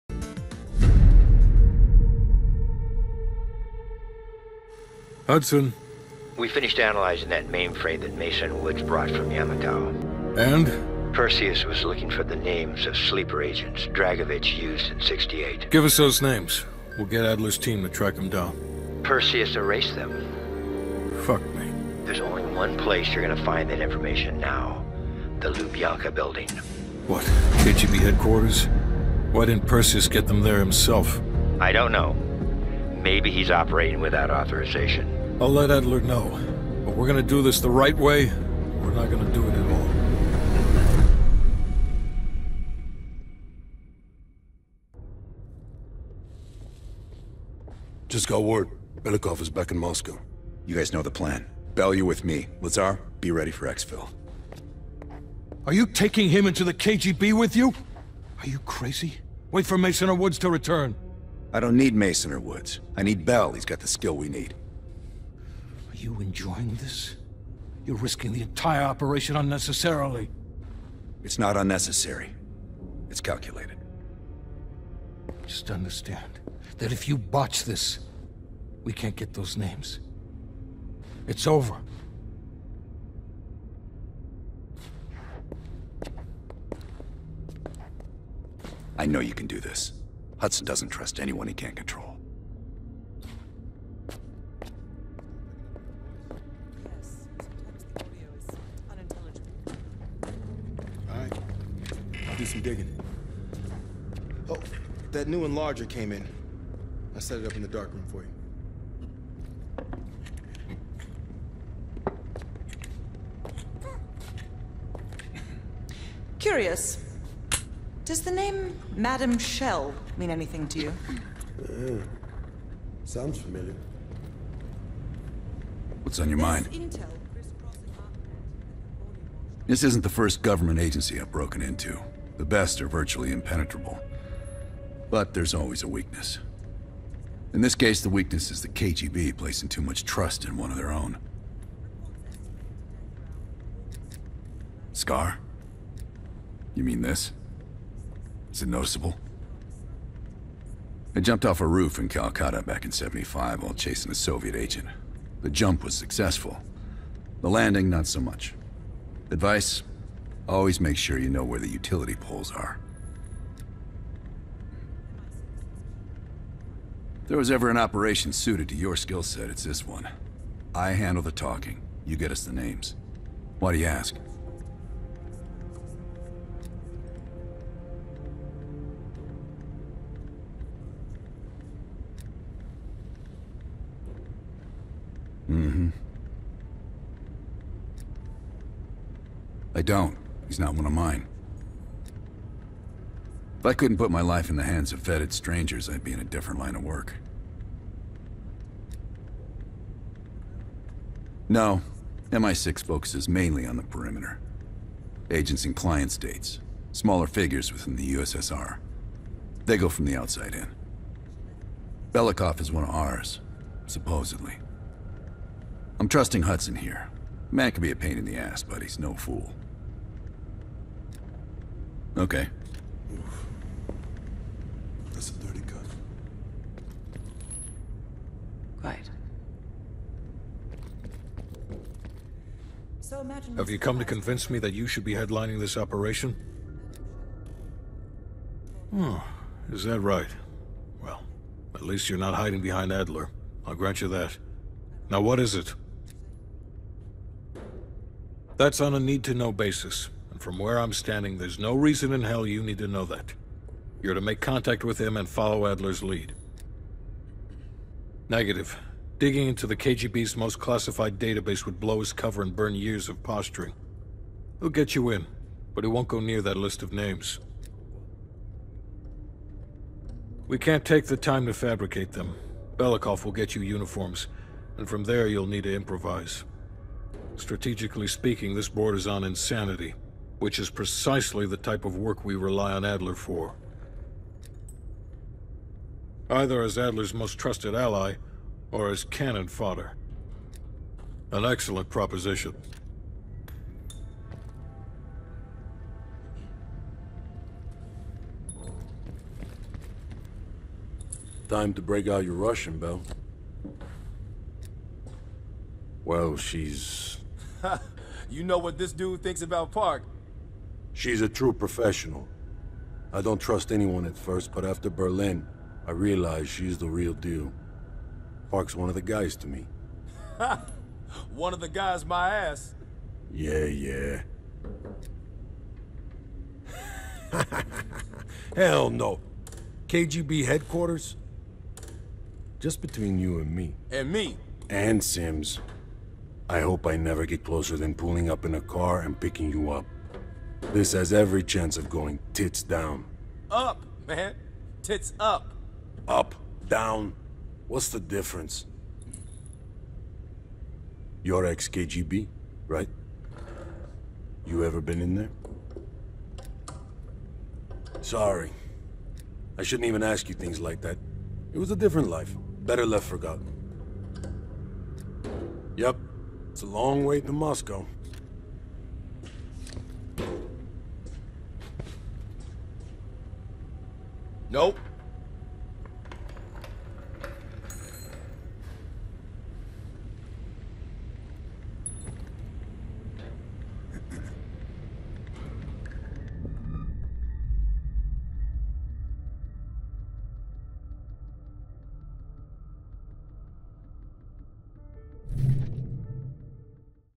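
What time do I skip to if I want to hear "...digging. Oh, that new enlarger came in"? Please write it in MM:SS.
01:42.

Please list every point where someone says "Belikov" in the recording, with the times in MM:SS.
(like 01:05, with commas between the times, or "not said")
00:49, 03:32, 04:32.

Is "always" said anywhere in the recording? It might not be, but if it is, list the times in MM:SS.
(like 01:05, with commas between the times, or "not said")
02:15, 02:40.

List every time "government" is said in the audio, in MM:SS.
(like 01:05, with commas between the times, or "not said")
02:10.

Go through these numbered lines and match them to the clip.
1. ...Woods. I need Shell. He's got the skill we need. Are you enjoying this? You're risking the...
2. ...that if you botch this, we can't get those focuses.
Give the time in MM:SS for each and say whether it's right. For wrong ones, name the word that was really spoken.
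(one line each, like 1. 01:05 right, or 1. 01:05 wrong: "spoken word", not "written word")
1. 01:02 wrong: "Bell", not "Shell"
2. 01:16 wrong: "names", not "focuses".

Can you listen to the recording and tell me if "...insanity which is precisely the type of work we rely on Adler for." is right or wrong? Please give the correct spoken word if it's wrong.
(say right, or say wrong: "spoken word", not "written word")
right.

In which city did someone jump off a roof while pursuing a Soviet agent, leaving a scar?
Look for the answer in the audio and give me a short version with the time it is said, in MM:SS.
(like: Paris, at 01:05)
Calcutta, at 02:32.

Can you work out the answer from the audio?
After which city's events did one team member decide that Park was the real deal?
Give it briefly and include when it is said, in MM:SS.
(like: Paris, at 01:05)
Berlin, at 05:14.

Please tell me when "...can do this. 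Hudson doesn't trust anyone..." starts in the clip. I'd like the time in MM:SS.
01:29.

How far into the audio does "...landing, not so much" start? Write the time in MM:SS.
02:37.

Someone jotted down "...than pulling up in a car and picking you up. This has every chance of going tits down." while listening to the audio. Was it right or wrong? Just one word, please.
right.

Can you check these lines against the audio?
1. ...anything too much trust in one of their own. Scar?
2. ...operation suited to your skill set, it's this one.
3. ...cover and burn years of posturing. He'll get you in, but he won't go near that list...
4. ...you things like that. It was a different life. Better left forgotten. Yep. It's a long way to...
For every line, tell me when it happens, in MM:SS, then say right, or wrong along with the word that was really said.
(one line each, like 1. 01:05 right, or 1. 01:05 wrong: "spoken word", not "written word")
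1. 02:19 wrong: "placing", not "anything"
2. 02:47 right
3. 04:22 right
4. 06:00 right.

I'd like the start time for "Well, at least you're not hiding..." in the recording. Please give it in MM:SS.
04:01.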